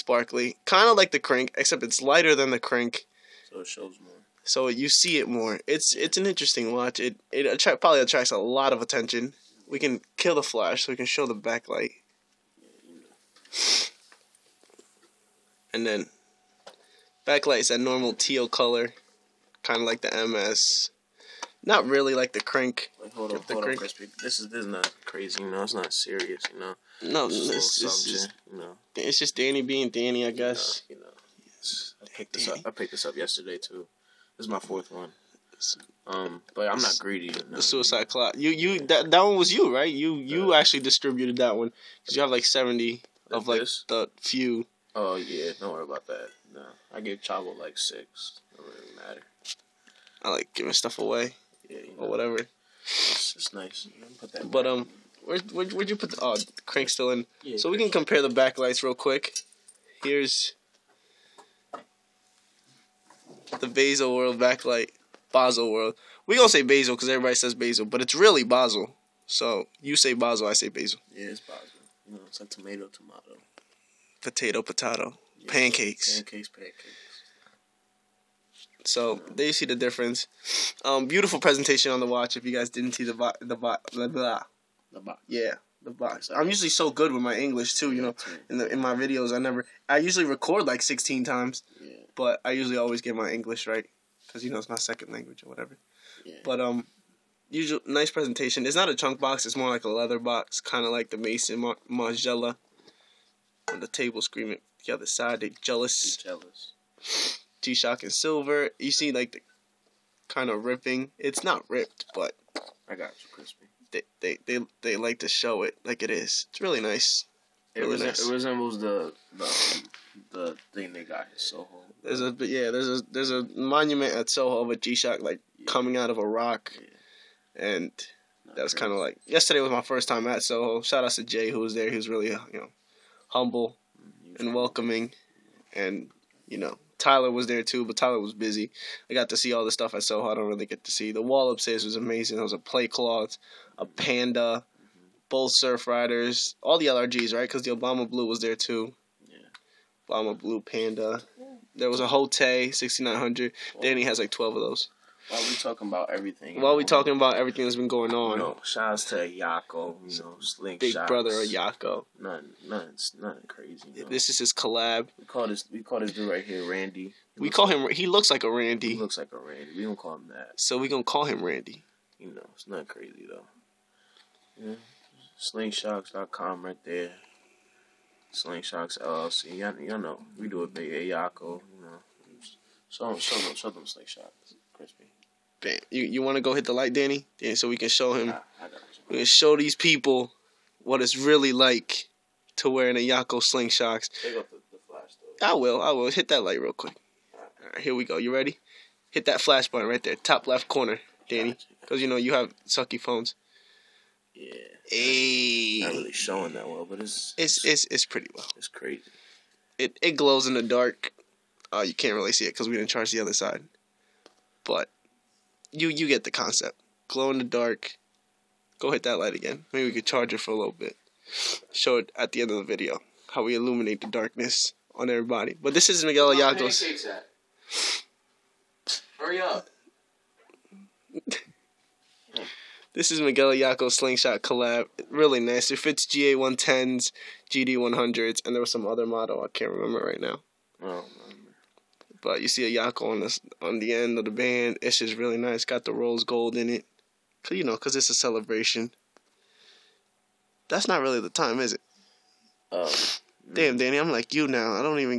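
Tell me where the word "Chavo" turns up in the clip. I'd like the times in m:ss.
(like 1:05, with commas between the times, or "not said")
0:47.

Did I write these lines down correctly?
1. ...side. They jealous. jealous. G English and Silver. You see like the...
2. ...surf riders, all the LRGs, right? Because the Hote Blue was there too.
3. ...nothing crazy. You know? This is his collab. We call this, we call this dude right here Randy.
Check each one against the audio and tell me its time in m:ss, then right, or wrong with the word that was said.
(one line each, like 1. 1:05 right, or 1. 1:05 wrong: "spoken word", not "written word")
1. 1:45 wrong: "Shock", not "English"
2. 2:25 wrong: "Obama", not "Hote"
3. 2:43 right.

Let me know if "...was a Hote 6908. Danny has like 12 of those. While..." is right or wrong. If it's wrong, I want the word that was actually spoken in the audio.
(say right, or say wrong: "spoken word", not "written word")
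wrong: "6900", not "6908".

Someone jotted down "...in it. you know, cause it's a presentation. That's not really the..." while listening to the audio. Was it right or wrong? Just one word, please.
wrong.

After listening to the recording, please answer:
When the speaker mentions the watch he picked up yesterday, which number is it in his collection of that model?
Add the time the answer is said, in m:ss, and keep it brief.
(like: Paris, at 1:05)
fourth, at 0:34.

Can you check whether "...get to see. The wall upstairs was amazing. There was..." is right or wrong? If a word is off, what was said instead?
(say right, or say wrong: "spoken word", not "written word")
right.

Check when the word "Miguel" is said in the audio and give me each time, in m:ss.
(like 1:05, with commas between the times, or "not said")
3:46, 3:53.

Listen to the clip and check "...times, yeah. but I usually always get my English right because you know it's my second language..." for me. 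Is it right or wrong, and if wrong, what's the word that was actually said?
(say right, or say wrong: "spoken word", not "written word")
right.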